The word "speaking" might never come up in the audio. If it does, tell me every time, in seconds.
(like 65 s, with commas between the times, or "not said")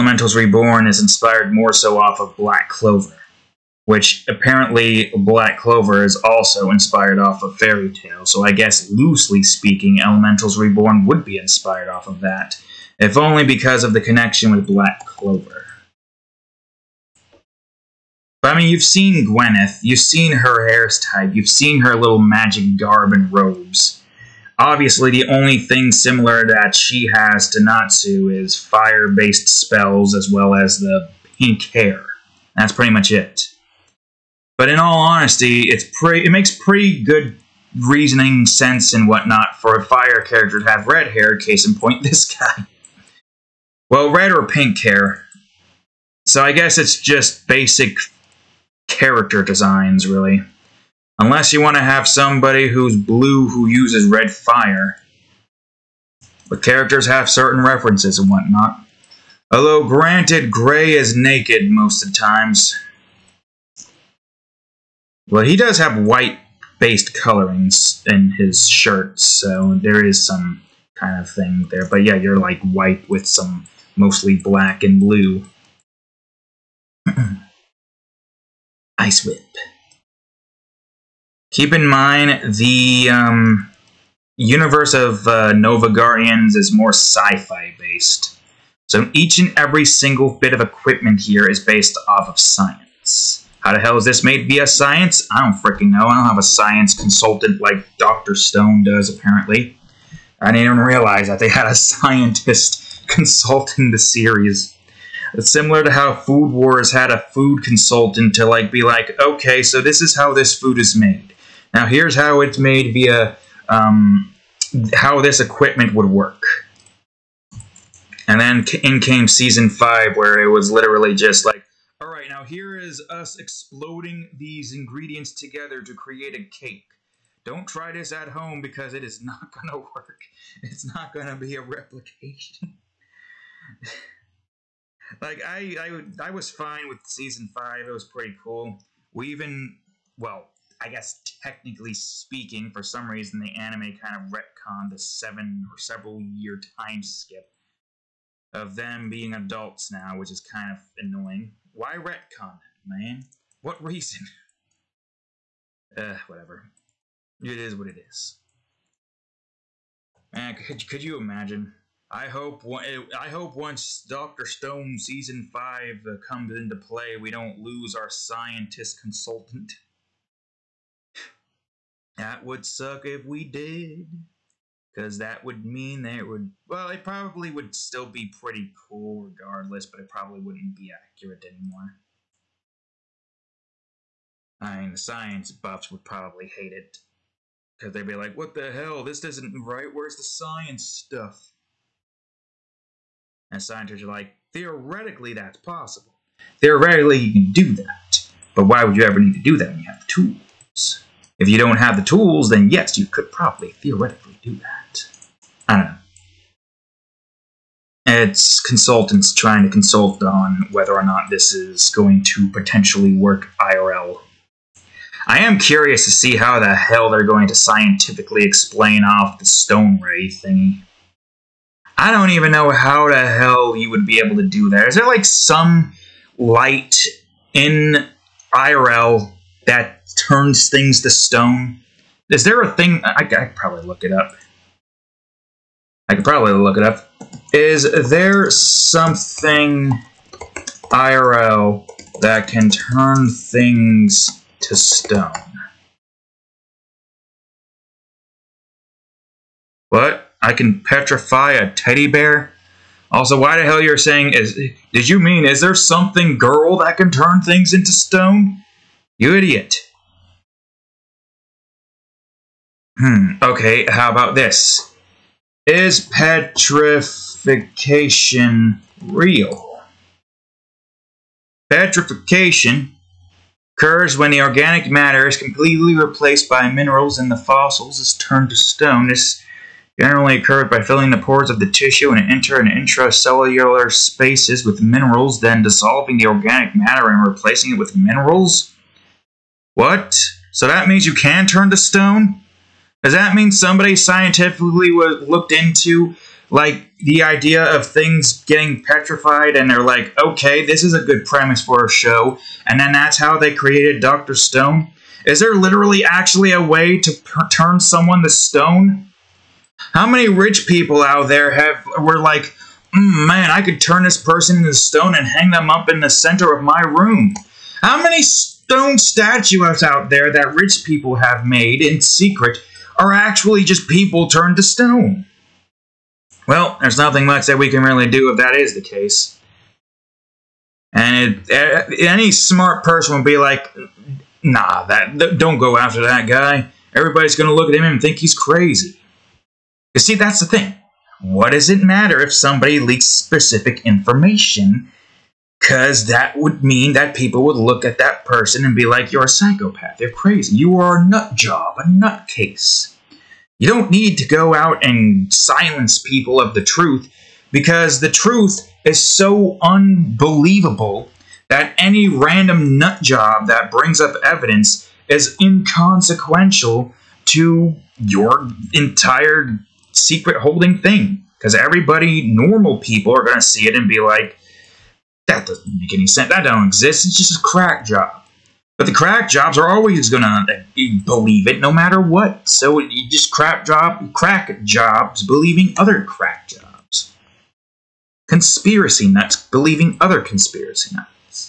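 9 s, 141 s.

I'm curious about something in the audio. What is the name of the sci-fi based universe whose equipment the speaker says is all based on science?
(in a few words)
Novagarians.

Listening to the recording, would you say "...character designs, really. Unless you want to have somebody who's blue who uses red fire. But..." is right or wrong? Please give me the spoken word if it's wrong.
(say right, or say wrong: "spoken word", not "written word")
right.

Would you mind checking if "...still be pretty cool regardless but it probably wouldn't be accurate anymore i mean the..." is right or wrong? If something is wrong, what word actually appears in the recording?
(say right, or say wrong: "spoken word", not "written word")
right.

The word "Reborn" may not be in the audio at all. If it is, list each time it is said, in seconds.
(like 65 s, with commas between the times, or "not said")
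0 s, 10 s.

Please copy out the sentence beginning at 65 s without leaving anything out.
Well, he does have white based colorings in his shirt, so there is some kind of thing there.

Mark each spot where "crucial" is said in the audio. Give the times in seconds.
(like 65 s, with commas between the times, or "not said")
not said.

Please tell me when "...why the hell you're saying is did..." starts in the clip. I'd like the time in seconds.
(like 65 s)
253 s.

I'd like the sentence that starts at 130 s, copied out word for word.
It's not going to be a replication.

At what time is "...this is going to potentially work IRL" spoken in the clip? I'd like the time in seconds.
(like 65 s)
211 s.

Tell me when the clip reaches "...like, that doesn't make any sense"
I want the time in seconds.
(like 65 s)
373 s.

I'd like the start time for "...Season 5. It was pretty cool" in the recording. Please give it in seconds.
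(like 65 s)
137 s.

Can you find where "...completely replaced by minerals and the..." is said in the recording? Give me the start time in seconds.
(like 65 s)
275 s.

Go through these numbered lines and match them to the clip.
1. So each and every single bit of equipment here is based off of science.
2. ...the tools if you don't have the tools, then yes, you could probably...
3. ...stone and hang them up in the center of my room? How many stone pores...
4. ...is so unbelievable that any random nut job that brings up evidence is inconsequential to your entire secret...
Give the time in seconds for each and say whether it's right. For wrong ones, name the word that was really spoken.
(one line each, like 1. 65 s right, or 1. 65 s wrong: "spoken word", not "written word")
1. 88 s right
2. 199 s right
3. 314 s wrong: "statues", not "pores"
4. 358 s right.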